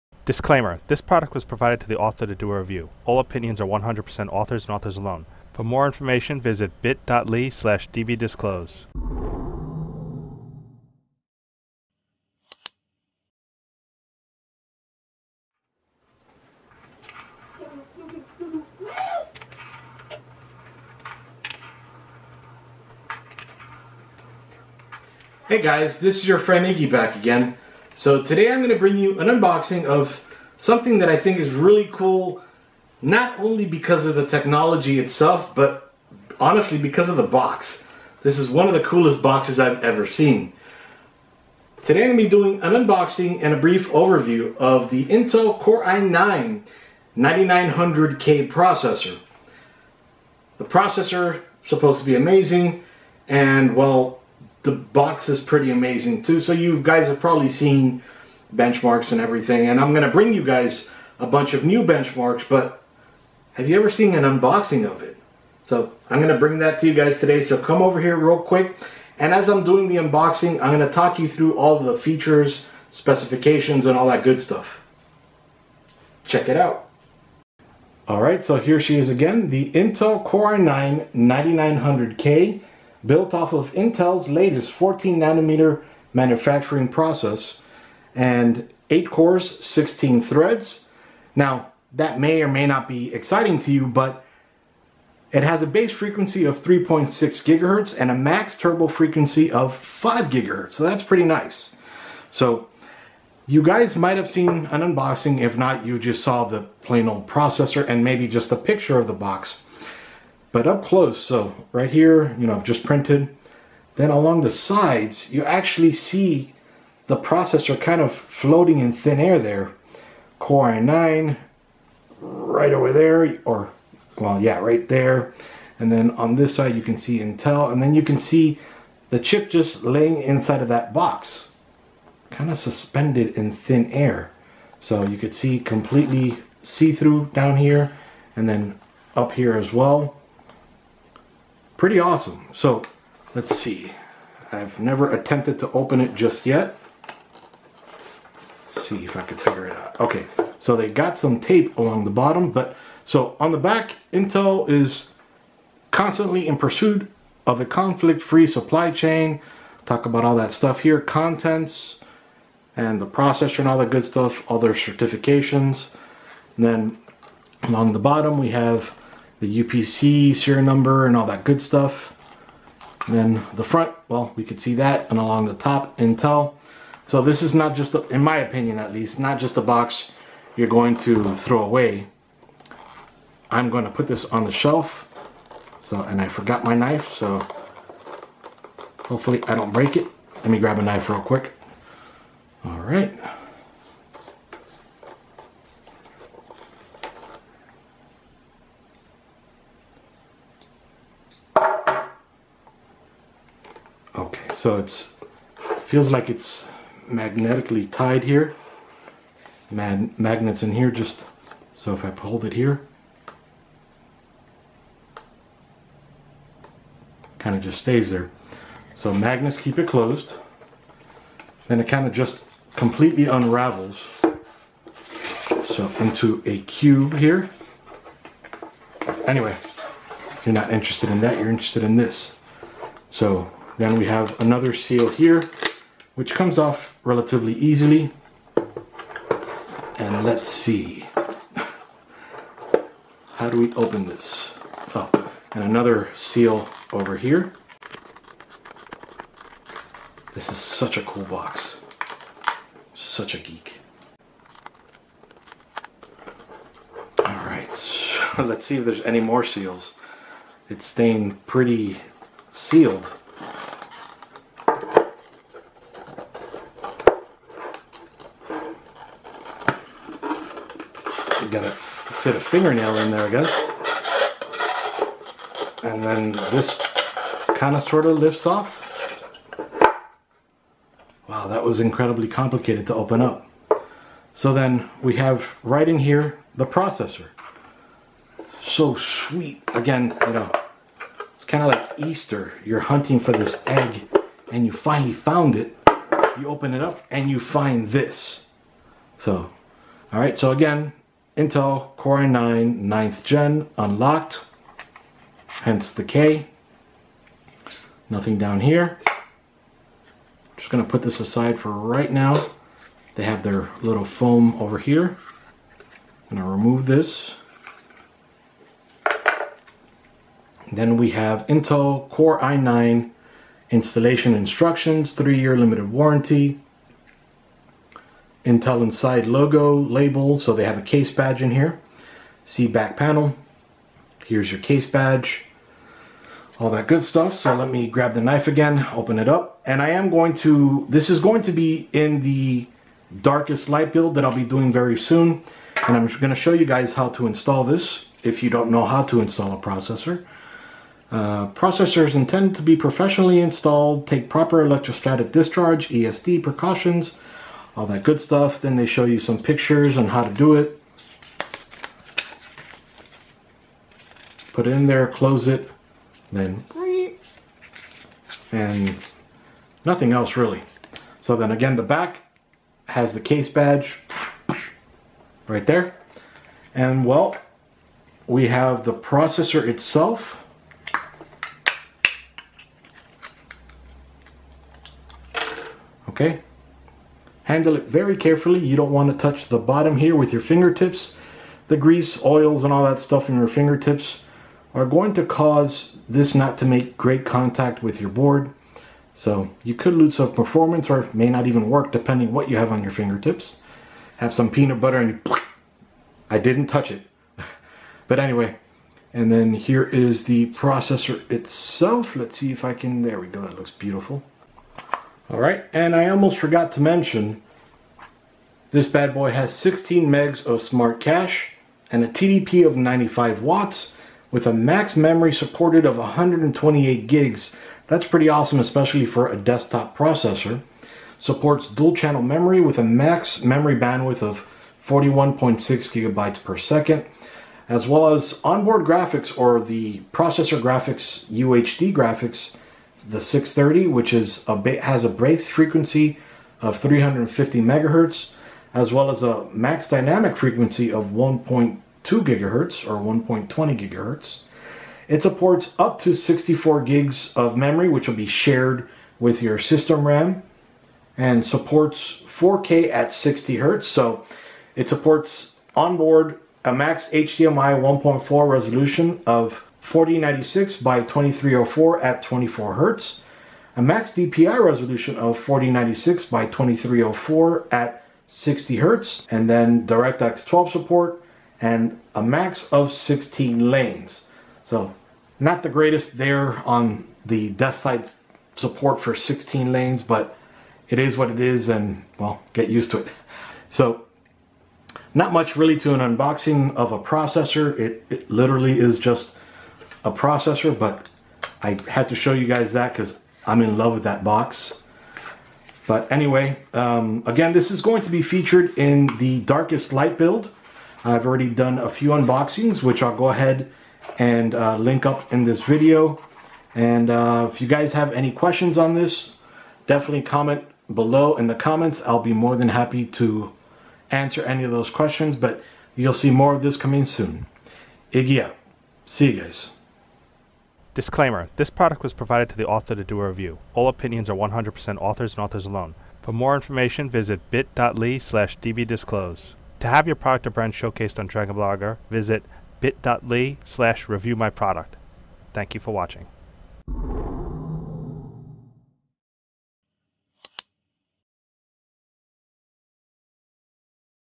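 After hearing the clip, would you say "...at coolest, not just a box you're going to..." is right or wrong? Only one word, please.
wrong.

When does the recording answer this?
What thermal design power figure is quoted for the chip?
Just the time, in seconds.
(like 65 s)
422 s.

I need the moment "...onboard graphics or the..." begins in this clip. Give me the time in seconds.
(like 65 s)
438 s.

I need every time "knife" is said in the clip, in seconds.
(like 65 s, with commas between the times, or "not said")
186 s, 190 s, 338 s.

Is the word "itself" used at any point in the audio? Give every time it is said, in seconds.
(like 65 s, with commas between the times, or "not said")
34 s, 379 s, 411 s.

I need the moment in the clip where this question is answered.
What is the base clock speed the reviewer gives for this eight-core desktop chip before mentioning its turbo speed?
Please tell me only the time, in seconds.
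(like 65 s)
96 s.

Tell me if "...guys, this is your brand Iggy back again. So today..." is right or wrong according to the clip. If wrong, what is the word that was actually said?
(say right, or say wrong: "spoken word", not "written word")
wrong: "friend", not "brand".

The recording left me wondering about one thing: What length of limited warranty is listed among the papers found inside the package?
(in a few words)
3 years.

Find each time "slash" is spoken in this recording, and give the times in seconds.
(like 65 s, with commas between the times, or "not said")
7 s, 538 s, 543 s.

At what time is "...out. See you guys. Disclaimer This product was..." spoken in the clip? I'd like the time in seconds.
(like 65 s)
528 s.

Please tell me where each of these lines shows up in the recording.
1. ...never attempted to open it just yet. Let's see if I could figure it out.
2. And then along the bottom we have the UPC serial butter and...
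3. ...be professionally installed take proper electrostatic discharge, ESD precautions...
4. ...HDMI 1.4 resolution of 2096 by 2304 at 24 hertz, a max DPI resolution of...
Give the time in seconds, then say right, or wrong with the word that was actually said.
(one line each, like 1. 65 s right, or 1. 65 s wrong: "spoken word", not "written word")
1. 144 s right
2. 166 s wrong: "number", not "butter"
3. 352 s right
4. 467 s wrong: "4096", not "2096".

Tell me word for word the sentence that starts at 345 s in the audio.
And I'm gonna show you guys how to install this if you don't know how to install a processor.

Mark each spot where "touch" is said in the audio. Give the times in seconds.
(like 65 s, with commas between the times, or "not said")
389 s, 406 s.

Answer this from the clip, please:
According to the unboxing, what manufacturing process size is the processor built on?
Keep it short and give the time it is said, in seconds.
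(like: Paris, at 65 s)
14 nanometer, at 84 s.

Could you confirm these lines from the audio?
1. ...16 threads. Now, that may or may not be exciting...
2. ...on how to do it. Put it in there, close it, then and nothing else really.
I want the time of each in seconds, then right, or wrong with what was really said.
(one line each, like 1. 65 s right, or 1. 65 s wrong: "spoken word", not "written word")
1. 89 s right
2. 359 s right.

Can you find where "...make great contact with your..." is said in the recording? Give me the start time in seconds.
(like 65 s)
396 s.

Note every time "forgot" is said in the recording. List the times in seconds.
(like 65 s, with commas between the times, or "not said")
186 s, 416 s.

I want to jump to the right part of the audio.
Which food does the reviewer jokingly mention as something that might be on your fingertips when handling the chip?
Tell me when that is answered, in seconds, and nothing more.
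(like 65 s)
404 s.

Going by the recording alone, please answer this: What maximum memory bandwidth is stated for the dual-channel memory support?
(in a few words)
41.6 GB/s.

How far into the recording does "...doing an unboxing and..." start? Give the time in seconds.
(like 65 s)
42 s.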